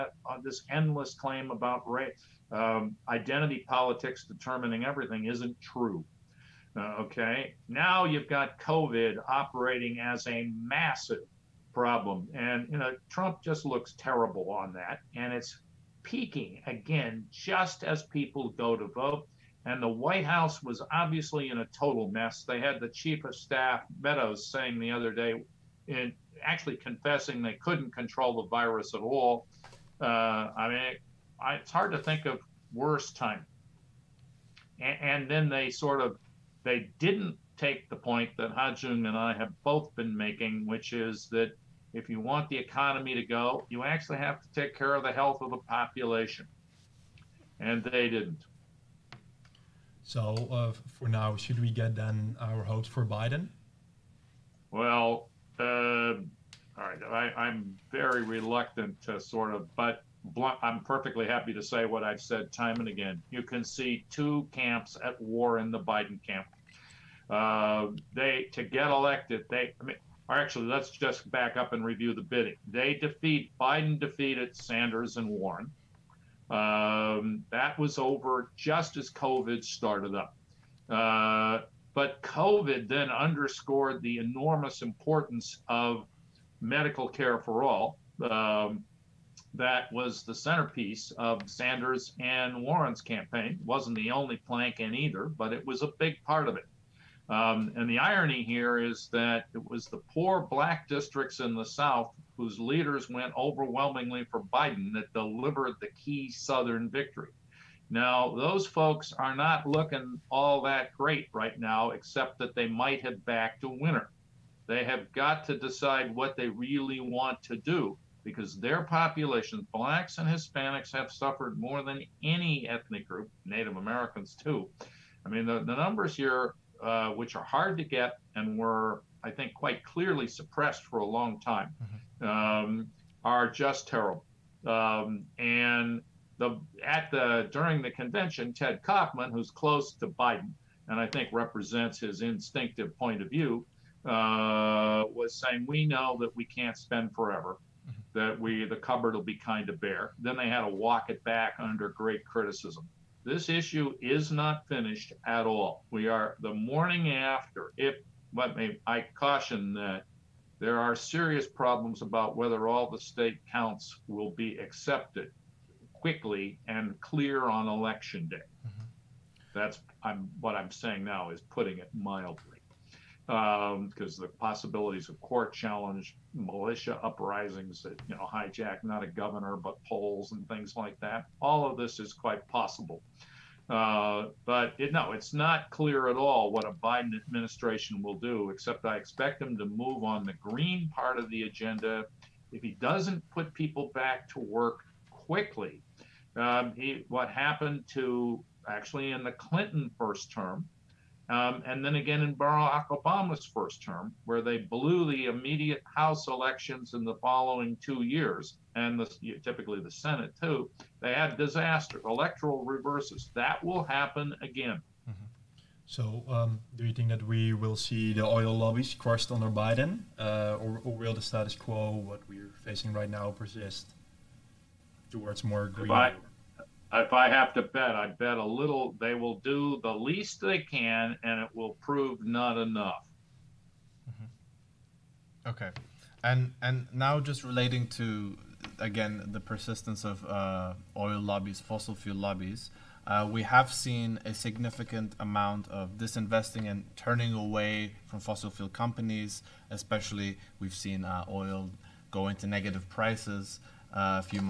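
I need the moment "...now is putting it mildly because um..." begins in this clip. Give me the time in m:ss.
2:51.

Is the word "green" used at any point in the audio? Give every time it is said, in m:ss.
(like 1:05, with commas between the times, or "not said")
3:10, 3:45.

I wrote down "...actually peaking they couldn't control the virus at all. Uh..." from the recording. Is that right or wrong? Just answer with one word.
wrong.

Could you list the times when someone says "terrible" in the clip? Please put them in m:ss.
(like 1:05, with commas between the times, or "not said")
0:13, 2:13.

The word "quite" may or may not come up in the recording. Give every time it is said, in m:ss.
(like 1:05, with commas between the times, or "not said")
2:09, 3:02.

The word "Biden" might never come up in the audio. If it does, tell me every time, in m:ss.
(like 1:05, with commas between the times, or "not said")
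0:53, 1:05, 1:13, 1:44, 2:20, 3:06, 3:39.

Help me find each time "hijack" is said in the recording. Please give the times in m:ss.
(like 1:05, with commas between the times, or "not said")
2:58.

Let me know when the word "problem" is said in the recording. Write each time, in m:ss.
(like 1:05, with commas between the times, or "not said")
0:11, 2:41.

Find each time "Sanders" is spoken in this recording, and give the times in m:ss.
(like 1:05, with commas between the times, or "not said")
1:14, 1:31.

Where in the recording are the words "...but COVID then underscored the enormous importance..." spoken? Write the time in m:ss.
1:21.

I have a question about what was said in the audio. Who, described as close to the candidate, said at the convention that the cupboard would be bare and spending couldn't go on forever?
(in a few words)
Ted Kaufman.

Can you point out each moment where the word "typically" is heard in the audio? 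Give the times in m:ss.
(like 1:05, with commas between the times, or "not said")
3:29.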